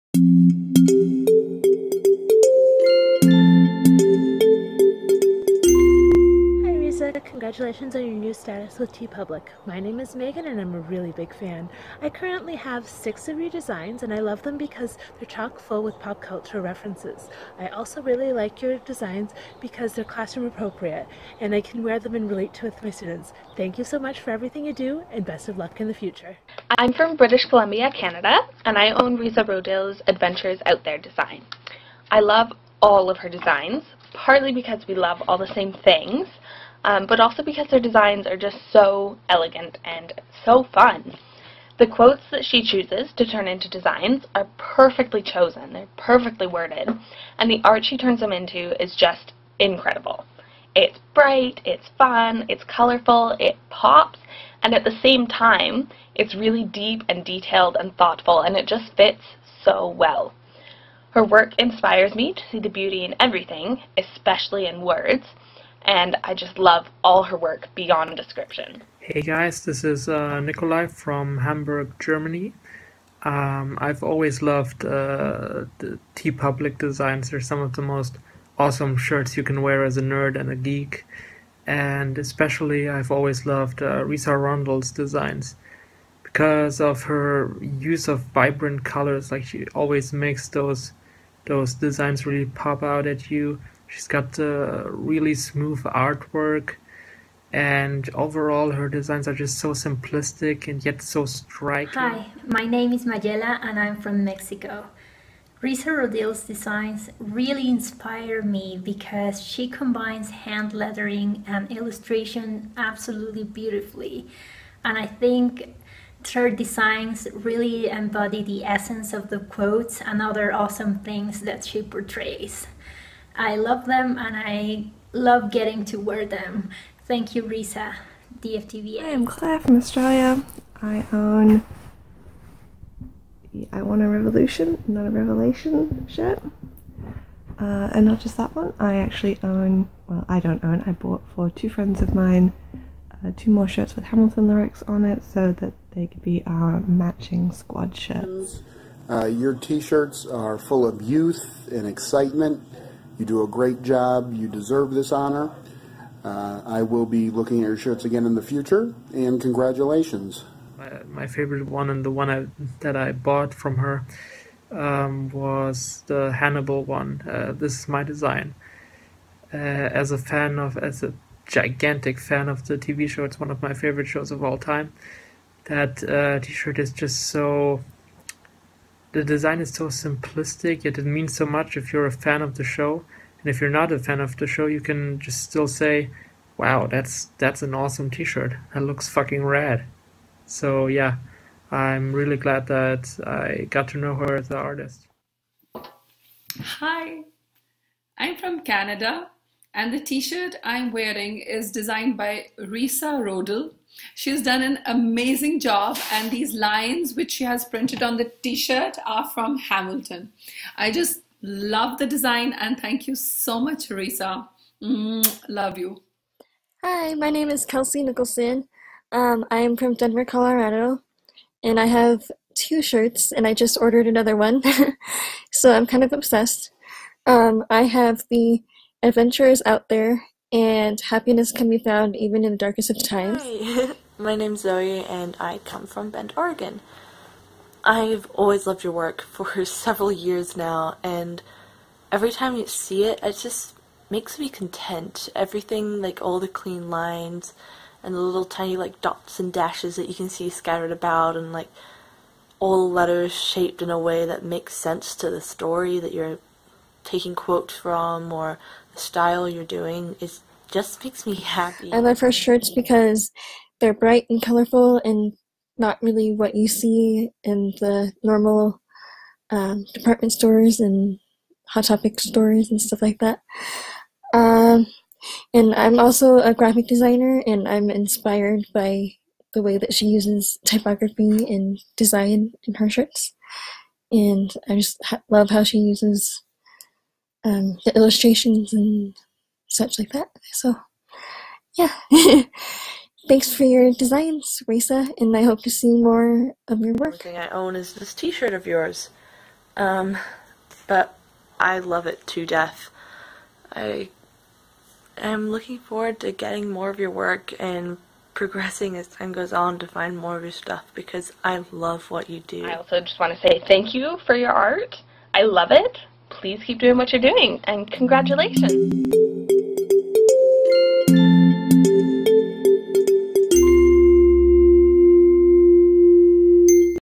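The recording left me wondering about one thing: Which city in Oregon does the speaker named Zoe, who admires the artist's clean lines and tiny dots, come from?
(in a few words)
Bend.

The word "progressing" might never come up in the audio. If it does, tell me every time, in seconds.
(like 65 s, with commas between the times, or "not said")
308 s.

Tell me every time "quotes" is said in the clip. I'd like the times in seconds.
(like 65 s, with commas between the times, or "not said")
41 s, 119 s, 257 s.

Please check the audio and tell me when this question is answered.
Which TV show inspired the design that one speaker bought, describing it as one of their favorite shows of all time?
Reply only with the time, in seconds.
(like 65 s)
166 s.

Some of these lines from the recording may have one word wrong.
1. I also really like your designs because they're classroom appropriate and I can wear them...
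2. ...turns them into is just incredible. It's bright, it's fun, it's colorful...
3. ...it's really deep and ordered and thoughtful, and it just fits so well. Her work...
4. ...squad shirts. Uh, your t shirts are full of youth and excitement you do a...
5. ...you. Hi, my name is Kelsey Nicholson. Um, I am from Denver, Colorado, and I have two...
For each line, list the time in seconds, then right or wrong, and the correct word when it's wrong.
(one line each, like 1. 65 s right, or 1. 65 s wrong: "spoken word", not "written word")
1. 17 s right
2. 47 s right
3. 56 s wrong: "detailed", not "ordered"
4. 147 s right
5. 215 s right.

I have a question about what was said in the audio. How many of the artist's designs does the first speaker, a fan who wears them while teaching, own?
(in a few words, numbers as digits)
6.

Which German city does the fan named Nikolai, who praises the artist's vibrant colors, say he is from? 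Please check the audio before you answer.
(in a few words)
Hamburg.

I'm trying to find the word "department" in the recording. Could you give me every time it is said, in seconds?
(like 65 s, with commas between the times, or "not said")
269 s.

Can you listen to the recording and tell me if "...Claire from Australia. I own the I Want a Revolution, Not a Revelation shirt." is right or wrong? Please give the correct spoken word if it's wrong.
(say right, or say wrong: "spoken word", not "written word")
right.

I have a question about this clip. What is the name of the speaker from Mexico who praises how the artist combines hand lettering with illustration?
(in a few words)
Mayela.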